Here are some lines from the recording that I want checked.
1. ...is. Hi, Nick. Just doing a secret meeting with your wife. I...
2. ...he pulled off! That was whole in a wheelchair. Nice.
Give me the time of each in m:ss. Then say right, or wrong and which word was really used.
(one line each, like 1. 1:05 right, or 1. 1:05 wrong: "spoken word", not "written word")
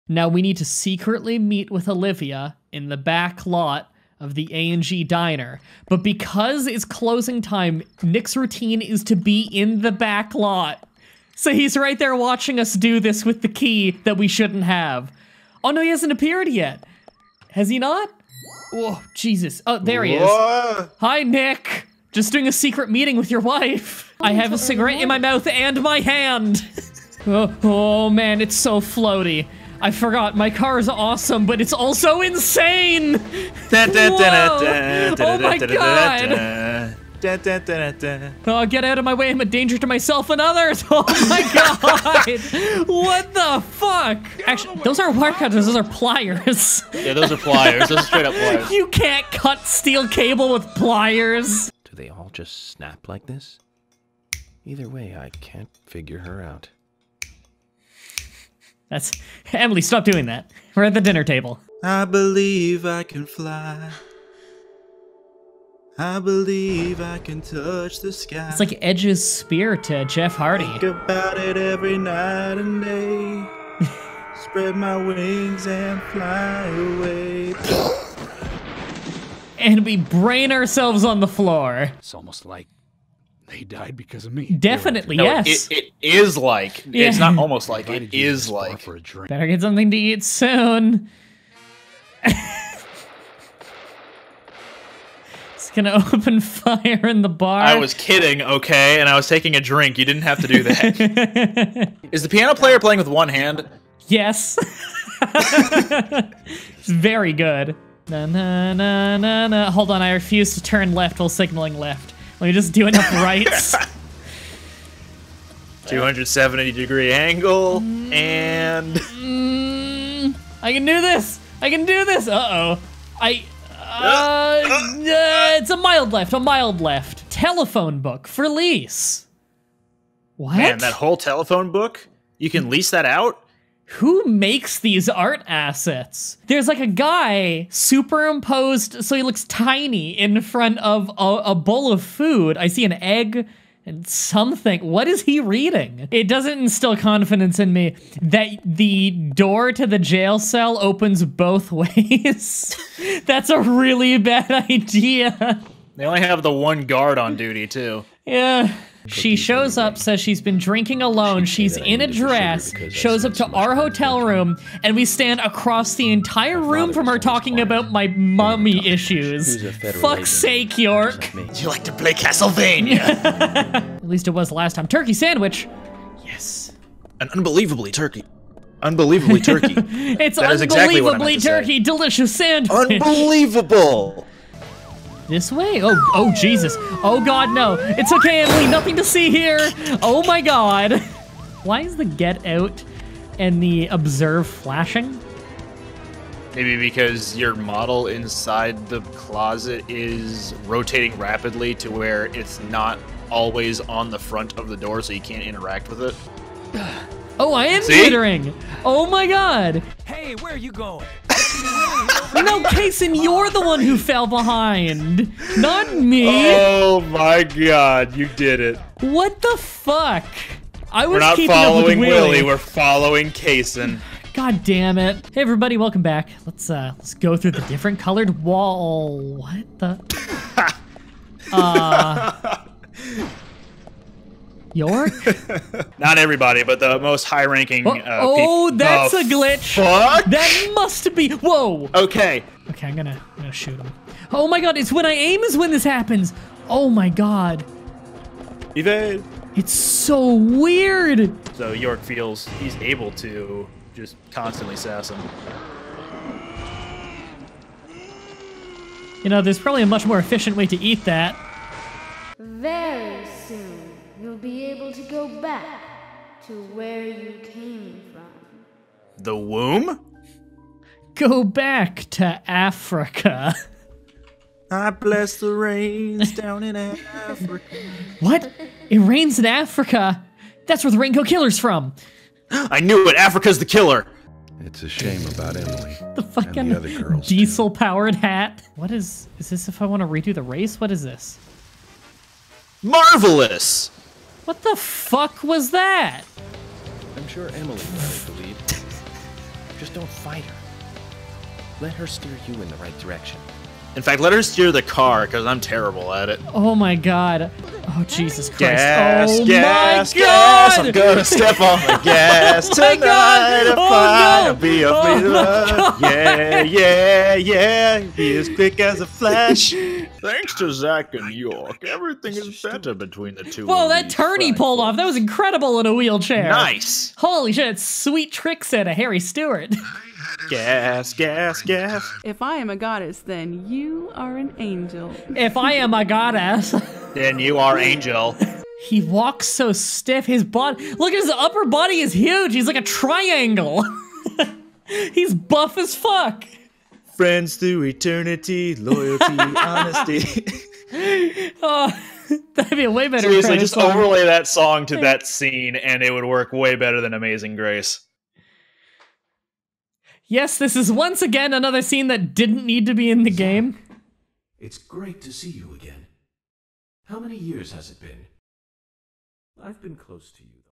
1. 0:20 right
2. 5:24 wrong: "incredible", not "whole".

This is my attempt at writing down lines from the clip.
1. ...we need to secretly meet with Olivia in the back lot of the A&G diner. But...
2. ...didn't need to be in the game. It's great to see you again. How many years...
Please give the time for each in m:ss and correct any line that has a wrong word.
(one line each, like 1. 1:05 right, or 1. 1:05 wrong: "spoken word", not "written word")
1. 0:00 right
2. 6:02 right.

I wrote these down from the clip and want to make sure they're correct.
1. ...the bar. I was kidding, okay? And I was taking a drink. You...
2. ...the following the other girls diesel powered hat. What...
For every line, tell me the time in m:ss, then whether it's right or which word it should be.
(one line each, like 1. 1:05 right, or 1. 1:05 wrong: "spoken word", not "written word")
1. 1:37 right
2. 4:46 wrong: "fucking", not "following".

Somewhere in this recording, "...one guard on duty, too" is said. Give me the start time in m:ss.
2:36.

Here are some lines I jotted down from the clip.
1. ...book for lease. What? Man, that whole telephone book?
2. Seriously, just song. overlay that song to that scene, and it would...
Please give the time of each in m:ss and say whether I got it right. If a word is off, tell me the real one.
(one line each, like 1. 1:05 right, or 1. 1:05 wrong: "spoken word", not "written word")
1. 2:07 right
2. 5:53 right.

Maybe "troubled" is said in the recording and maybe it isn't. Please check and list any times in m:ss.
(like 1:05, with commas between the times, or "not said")
not said.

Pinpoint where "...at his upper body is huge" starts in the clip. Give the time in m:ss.
5:41.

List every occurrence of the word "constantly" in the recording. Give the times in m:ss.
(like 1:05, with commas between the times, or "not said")
4:14.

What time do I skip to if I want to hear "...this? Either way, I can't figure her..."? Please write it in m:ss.
0:53.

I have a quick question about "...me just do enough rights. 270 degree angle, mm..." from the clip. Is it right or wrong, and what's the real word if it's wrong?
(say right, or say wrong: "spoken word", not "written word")
right.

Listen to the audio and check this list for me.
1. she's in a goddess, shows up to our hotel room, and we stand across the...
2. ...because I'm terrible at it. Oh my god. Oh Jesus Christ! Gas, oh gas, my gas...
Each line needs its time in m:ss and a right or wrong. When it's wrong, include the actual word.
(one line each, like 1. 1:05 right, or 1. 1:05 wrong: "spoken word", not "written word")
1. 2:41 wrong: "dress", not "goddess"
2. 5:05 right.